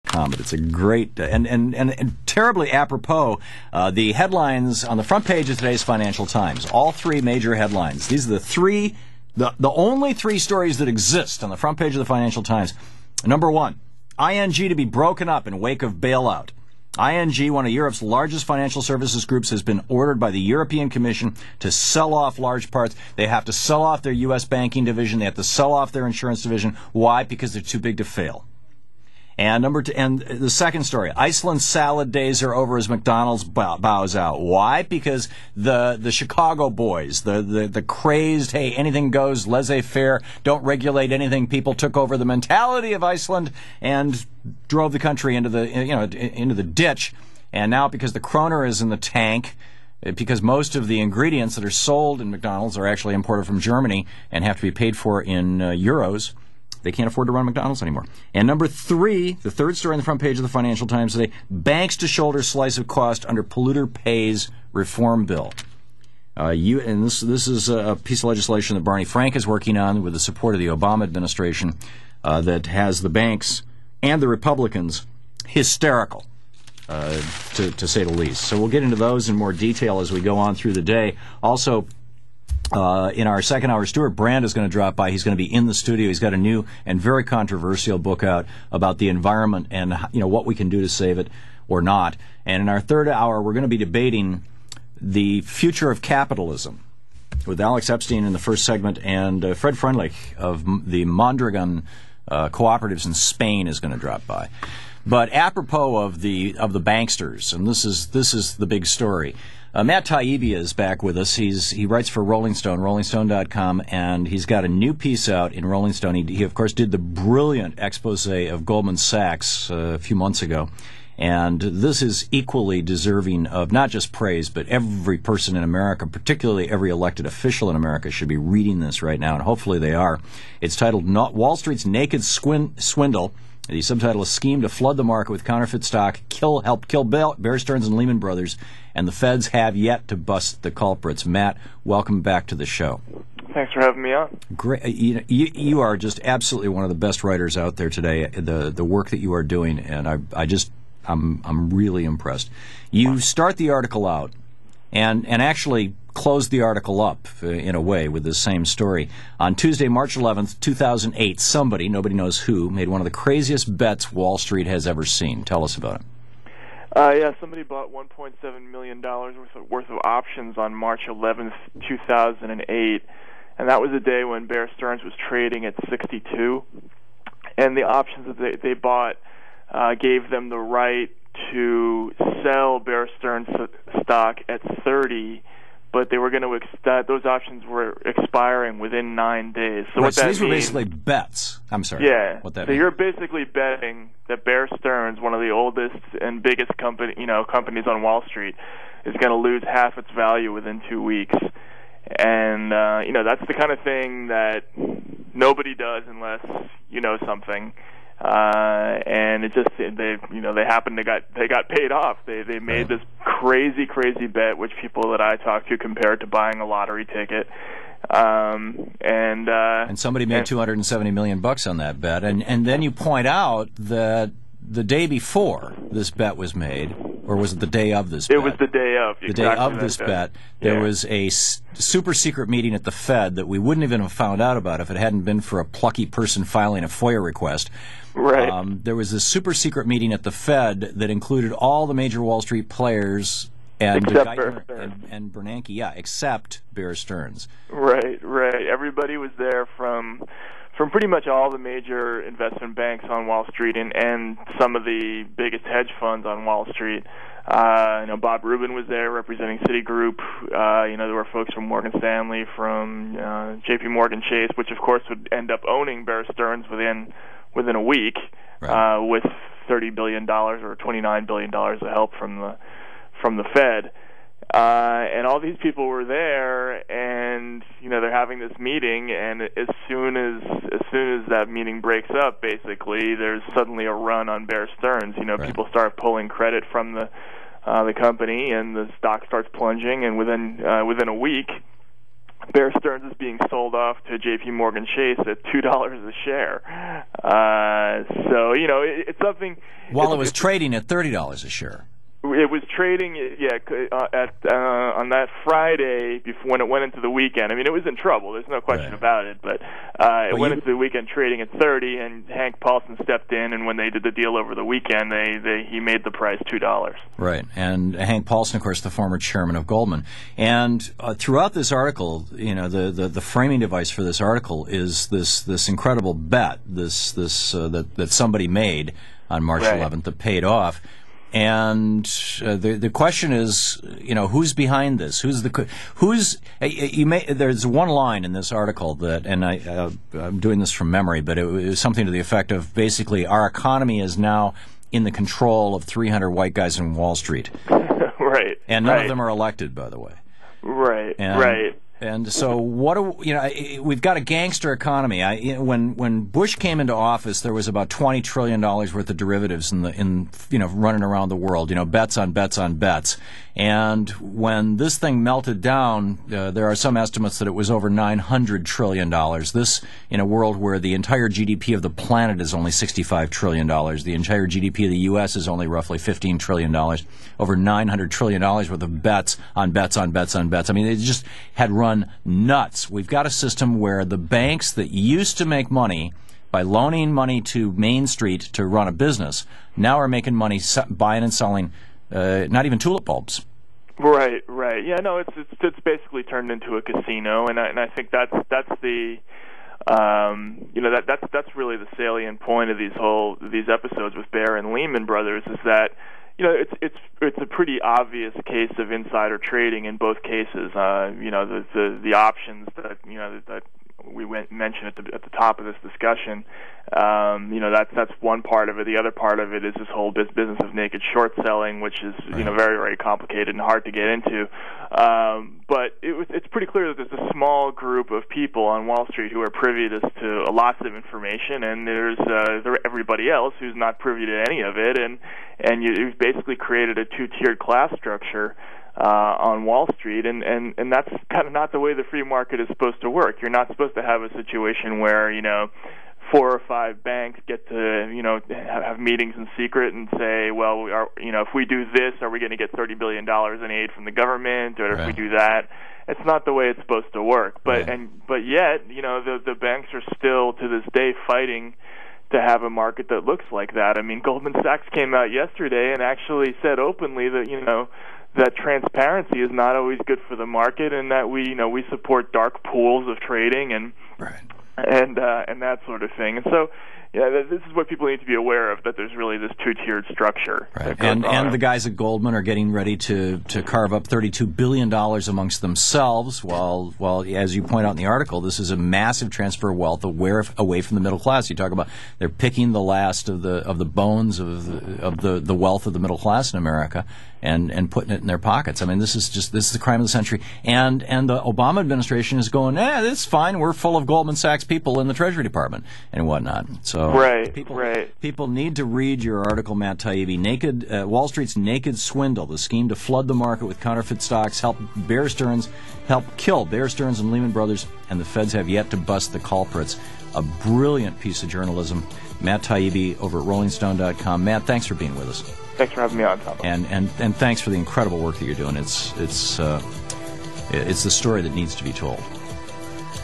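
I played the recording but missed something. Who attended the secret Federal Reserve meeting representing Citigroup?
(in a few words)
Bob Rubin.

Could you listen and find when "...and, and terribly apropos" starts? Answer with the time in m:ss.
0:01.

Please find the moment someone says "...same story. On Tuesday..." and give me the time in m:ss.
2:38.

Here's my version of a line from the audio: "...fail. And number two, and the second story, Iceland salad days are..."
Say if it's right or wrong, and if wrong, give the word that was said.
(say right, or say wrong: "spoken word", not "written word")
right.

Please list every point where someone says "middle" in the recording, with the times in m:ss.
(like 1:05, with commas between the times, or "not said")
8:11, 8:15.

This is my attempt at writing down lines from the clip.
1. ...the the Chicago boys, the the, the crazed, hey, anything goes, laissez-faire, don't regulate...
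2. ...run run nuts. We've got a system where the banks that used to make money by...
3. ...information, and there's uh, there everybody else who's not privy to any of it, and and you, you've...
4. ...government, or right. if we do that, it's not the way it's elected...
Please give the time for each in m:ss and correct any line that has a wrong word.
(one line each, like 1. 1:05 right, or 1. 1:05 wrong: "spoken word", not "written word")
1. 0:35 right
2. 6:21 right
3. 7:10 right
4. 7:34 wrong: "supposed", not "elected".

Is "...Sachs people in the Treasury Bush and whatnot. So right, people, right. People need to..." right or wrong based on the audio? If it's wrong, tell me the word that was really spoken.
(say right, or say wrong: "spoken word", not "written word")
wrong: "Department", not "Bush".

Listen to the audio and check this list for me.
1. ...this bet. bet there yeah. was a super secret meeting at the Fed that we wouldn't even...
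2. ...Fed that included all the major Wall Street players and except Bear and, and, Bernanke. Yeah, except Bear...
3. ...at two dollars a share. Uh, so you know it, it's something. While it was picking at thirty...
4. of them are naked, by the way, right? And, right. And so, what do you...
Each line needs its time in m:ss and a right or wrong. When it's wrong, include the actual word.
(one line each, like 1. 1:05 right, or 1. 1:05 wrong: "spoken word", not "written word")
1. 3:49 right
2. 4:00 right
3. 4:55 wrong: "trading", not "picking"
4. 5:49 wrong: "elected", not "naked".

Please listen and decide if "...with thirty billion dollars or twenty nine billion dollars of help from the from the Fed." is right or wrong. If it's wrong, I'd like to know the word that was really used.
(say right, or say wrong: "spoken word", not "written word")
right.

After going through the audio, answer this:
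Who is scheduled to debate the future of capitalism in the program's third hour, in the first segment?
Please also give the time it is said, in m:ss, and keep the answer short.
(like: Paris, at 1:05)
Alex Epstein, at 1:37.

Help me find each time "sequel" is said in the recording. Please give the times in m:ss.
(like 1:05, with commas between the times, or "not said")
not said.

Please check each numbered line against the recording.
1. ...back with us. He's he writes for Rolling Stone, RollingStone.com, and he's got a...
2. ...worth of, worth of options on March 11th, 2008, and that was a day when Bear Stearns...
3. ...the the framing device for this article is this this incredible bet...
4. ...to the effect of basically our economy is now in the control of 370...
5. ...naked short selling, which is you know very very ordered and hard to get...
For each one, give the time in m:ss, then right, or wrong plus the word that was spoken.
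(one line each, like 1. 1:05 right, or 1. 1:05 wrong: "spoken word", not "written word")
1. 1:50 right
2. 2:49 right
3. 5:22 right
4. 5:42 wrong: "300", not "370"
5. 7:00 wrong: "complicated", not "ordered".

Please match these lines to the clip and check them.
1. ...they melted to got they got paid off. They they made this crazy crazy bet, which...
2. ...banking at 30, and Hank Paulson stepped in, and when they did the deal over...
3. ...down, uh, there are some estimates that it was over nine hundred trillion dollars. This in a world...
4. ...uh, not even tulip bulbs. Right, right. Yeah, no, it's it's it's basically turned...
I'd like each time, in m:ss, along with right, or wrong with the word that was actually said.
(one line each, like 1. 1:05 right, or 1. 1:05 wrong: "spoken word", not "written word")
1. 3:30 wrong: "happened", not "melted"
2. 5:11 wrong: "trading", not "banking"
3. 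6:05 right
4. 6:32 right.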